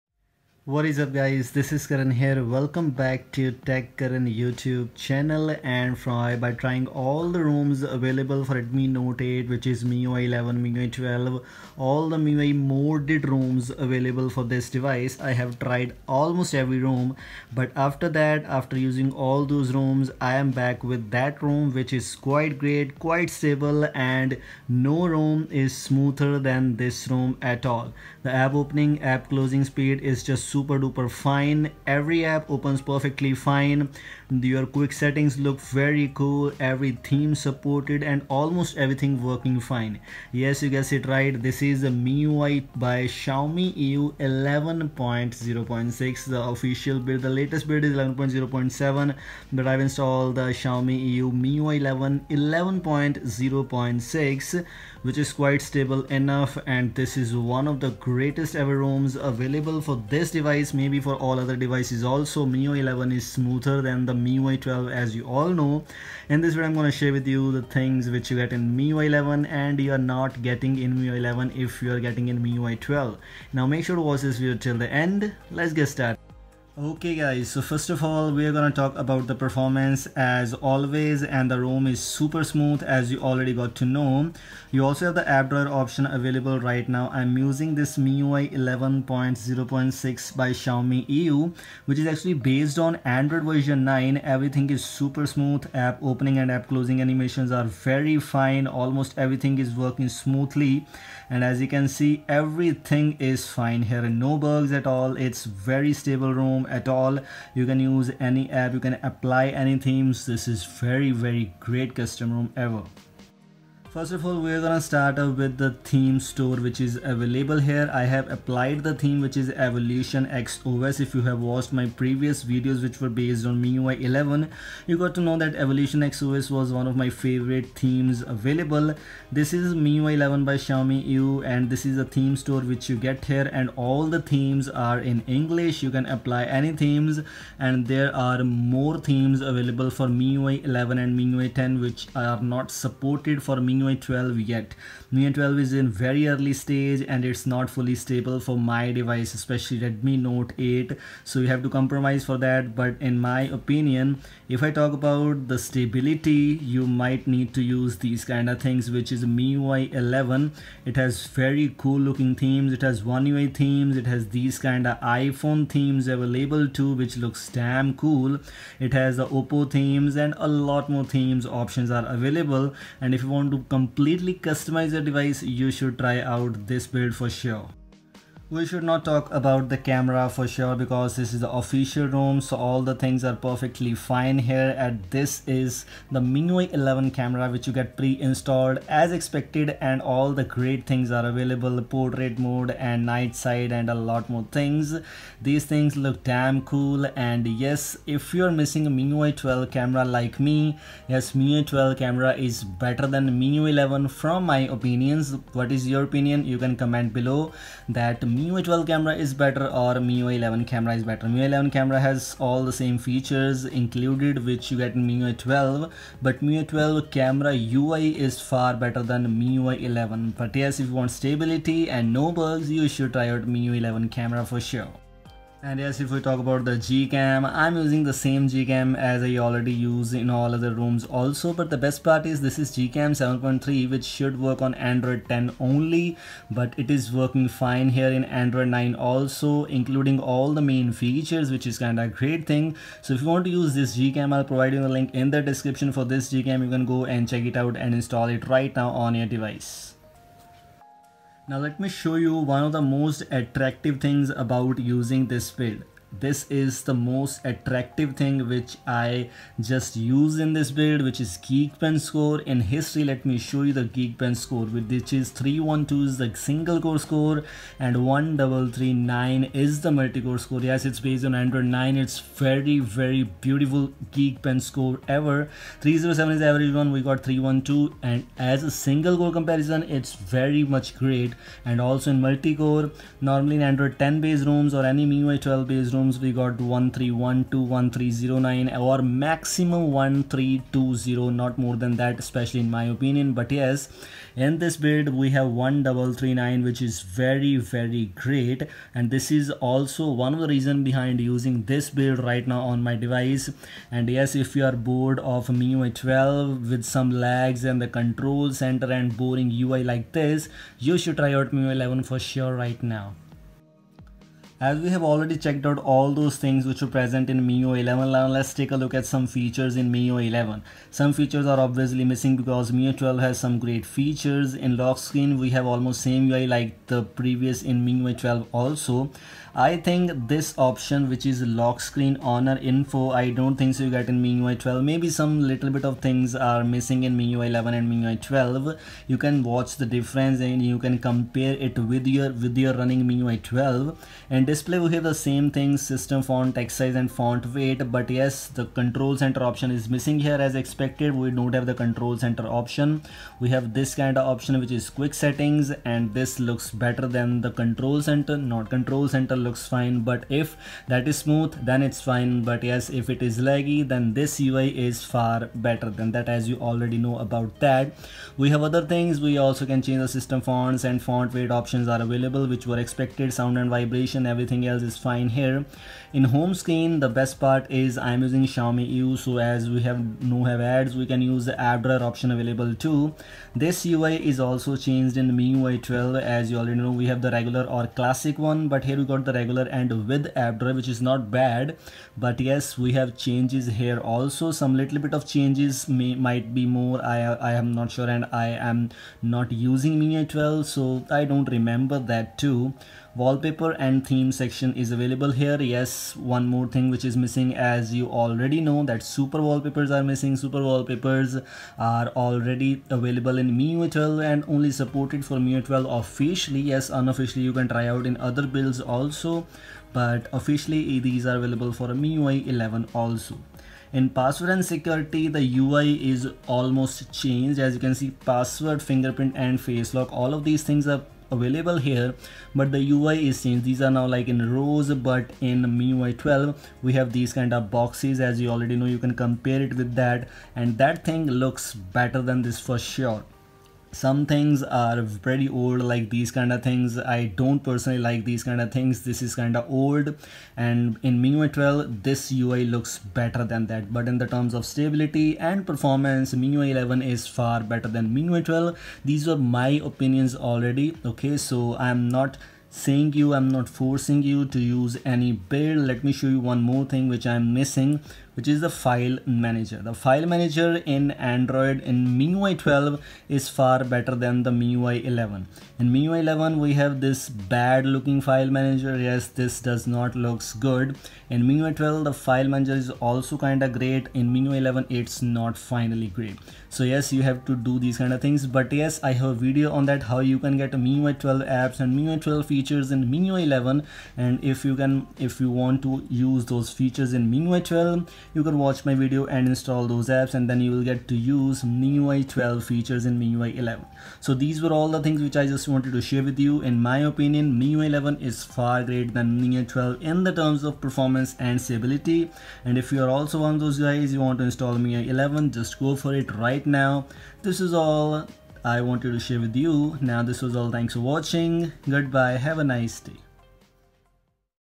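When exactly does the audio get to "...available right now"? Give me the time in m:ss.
1:26.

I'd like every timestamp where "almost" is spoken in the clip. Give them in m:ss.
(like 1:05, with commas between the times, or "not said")
0:16, 0:38, 1:38, 5:25, 7:06.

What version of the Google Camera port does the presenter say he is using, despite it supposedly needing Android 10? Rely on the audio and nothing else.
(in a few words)
7.3.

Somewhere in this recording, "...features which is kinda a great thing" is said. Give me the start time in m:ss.
4:00.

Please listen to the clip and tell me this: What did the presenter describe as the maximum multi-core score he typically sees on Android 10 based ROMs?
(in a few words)
1320.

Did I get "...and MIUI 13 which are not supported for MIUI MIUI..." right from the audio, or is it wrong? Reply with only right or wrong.
wrong.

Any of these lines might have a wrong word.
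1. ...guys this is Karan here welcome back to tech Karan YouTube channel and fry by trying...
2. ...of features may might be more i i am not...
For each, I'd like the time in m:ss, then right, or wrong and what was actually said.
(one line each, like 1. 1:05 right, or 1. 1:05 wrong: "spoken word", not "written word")
1. 0:01 right
2. 6:35 wrong: "changes", not "features".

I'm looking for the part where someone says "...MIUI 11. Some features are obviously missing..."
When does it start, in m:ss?
5:19.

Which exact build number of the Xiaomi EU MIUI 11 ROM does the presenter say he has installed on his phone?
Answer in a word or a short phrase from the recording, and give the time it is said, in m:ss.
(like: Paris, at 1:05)
11.0.6, at 0:50.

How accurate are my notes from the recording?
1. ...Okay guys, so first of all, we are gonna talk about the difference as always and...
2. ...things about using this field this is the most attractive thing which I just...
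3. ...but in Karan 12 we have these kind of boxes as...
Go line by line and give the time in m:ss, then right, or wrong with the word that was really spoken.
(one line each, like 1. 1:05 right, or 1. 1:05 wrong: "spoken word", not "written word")
1. 1:16 wrong: "performance", not "difference"
2. 4:13 right
3. 7:14 wrong: "MIUI", not "Karan".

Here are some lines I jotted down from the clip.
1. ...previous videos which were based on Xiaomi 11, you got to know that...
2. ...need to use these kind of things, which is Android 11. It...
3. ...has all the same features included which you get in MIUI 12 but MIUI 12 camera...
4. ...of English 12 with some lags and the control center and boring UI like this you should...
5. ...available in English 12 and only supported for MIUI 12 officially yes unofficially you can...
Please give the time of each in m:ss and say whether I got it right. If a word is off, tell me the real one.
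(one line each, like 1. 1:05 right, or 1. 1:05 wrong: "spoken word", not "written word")
1. 2:02 wrong: "MIUI", not "Xiaomi"
2. 2:37 wrong: "MIUI", not "Android"
3. 3:32 right
4. 5:05 wrong: "MIUI", not "English"
5. 6:52 wrong: "MIUI", not "English".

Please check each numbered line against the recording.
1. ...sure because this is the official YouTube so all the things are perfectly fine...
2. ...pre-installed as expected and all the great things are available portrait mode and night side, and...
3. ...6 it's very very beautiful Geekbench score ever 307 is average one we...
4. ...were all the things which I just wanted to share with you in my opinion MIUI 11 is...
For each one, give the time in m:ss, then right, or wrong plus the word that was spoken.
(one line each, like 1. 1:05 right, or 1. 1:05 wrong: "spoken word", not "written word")
1. 3:00 wrong: "ROM", not "YouTube"
2. 3:07 right
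3. 4:31 wrong: "9", not "6"
4. 8:24 right.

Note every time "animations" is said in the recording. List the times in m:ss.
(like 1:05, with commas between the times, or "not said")
1:37.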